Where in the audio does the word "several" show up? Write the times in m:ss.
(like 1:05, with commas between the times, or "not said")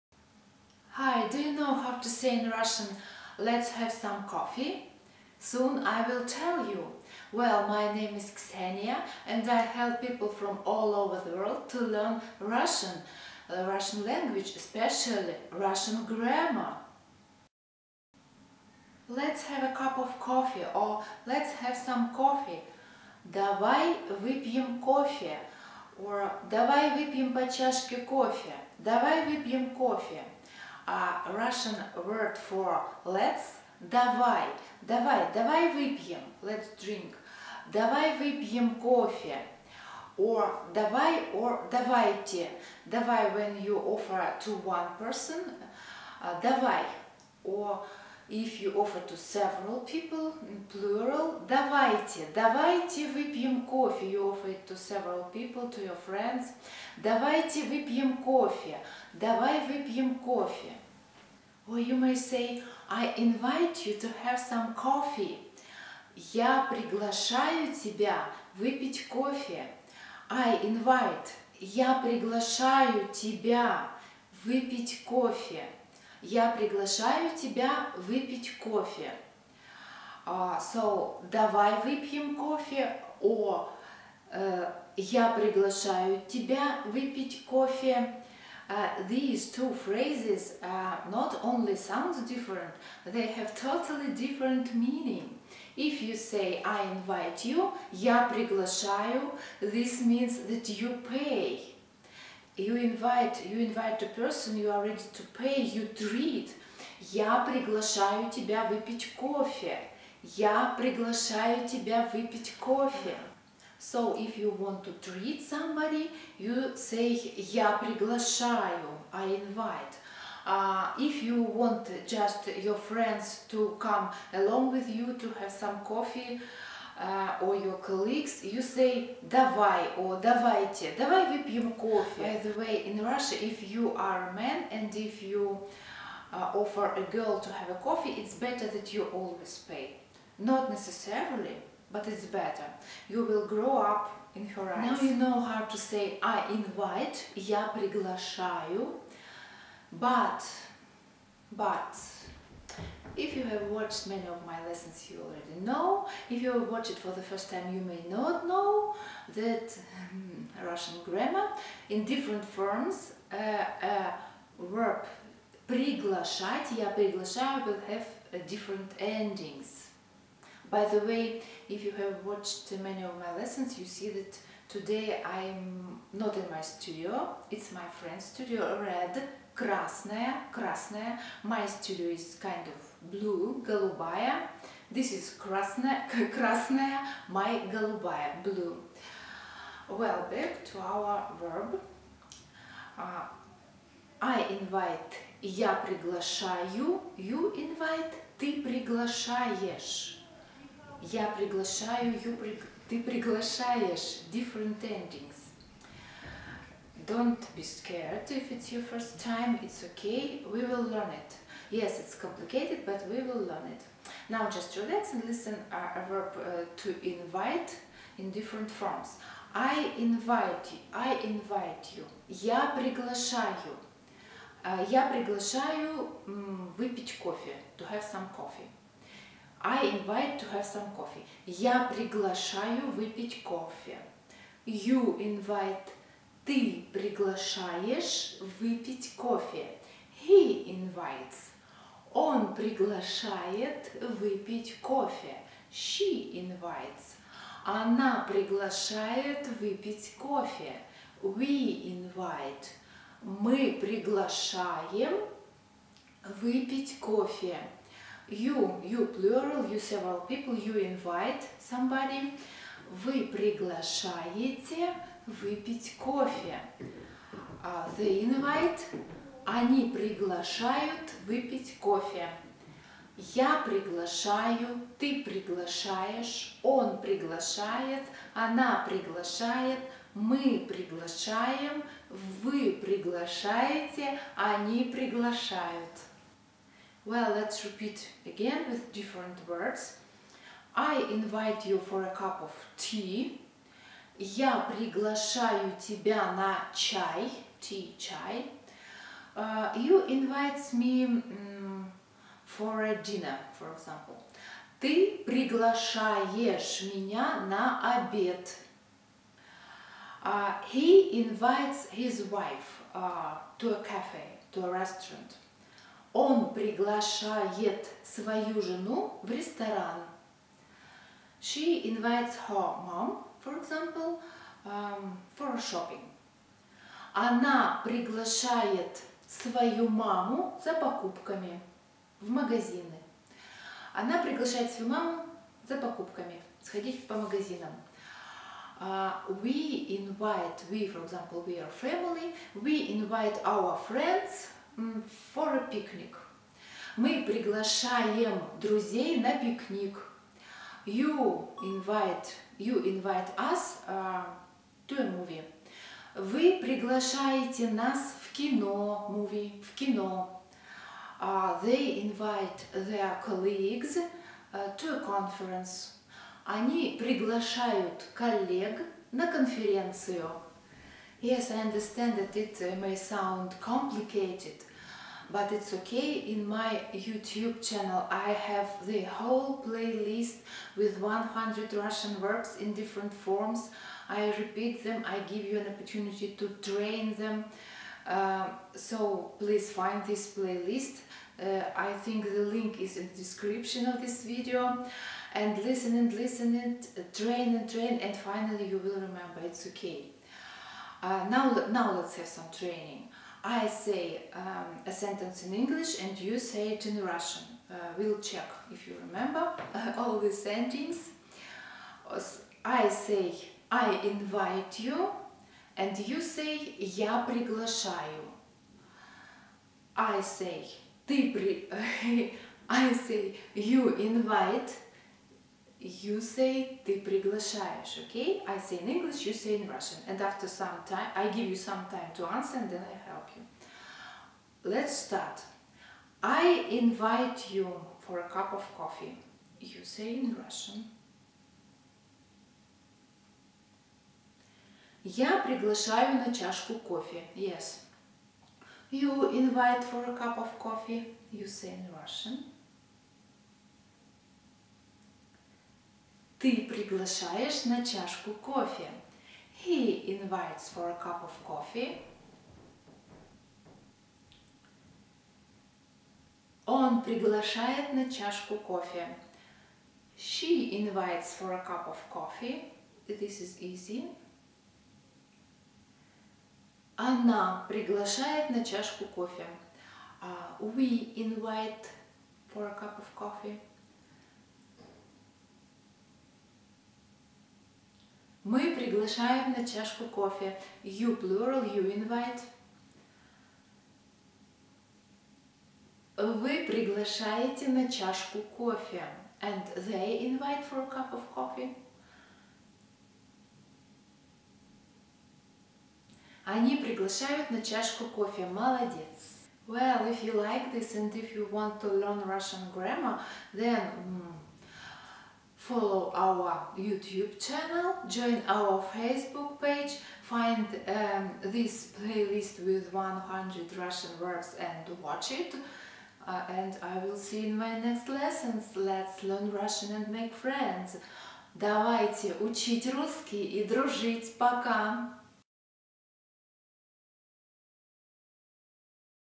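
0:49, 0:54, 4:19.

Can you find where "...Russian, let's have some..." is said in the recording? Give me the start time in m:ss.
0:02.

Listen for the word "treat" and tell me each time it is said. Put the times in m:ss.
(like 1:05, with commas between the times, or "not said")
1:45, 1:55.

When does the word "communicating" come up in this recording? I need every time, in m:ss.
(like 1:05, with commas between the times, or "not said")
not said.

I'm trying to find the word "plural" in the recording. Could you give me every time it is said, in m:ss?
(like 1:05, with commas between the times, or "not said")
0:50, 4:19, 8:11.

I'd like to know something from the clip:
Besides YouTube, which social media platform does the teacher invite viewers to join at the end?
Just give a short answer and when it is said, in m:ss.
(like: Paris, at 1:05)
Facebook, at 8:38.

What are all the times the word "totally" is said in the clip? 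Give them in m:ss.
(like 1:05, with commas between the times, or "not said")
1:33.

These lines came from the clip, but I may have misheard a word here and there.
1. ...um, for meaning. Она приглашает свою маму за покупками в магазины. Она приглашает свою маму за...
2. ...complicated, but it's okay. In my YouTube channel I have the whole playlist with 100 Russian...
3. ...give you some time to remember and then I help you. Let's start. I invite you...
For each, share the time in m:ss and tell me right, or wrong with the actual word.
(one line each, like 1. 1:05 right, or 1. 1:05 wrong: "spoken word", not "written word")
1. 5:24 wrong: "shopping", not "meaning"
2. 6:13 right
3. 7:11 wrong: "answer", not "remember".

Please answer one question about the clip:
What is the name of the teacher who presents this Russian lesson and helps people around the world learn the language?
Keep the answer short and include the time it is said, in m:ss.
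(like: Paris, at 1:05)
Ksenia, at 0:08.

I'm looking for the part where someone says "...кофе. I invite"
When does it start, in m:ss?
1:09.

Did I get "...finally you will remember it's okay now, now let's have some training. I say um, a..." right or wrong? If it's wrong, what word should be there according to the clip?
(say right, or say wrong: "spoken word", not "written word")
right.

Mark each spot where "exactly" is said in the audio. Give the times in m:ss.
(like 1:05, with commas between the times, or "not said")
not said.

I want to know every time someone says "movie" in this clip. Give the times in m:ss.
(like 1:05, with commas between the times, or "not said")
5:55, 5:59.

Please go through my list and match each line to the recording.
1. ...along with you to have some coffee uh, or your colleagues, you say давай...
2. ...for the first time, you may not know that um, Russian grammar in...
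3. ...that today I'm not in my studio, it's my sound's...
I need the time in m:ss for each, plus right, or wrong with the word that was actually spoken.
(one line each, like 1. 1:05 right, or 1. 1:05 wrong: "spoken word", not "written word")
1. 2:04 right
2. 2:36 right
3. 2:54 wrong: "friend", not "sound".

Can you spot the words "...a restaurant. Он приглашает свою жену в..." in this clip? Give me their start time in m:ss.
5:14.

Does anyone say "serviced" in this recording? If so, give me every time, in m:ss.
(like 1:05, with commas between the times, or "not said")
not said.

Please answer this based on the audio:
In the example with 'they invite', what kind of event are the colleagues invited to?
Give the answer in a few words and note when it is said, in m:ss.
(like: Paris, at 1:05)
A conference, at 6:09.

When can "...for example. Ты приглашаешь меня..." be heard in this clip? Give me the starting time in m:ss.
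5:03.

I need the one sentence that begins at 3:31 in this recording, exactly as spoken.
Yes, it's complicated, but we will learn it.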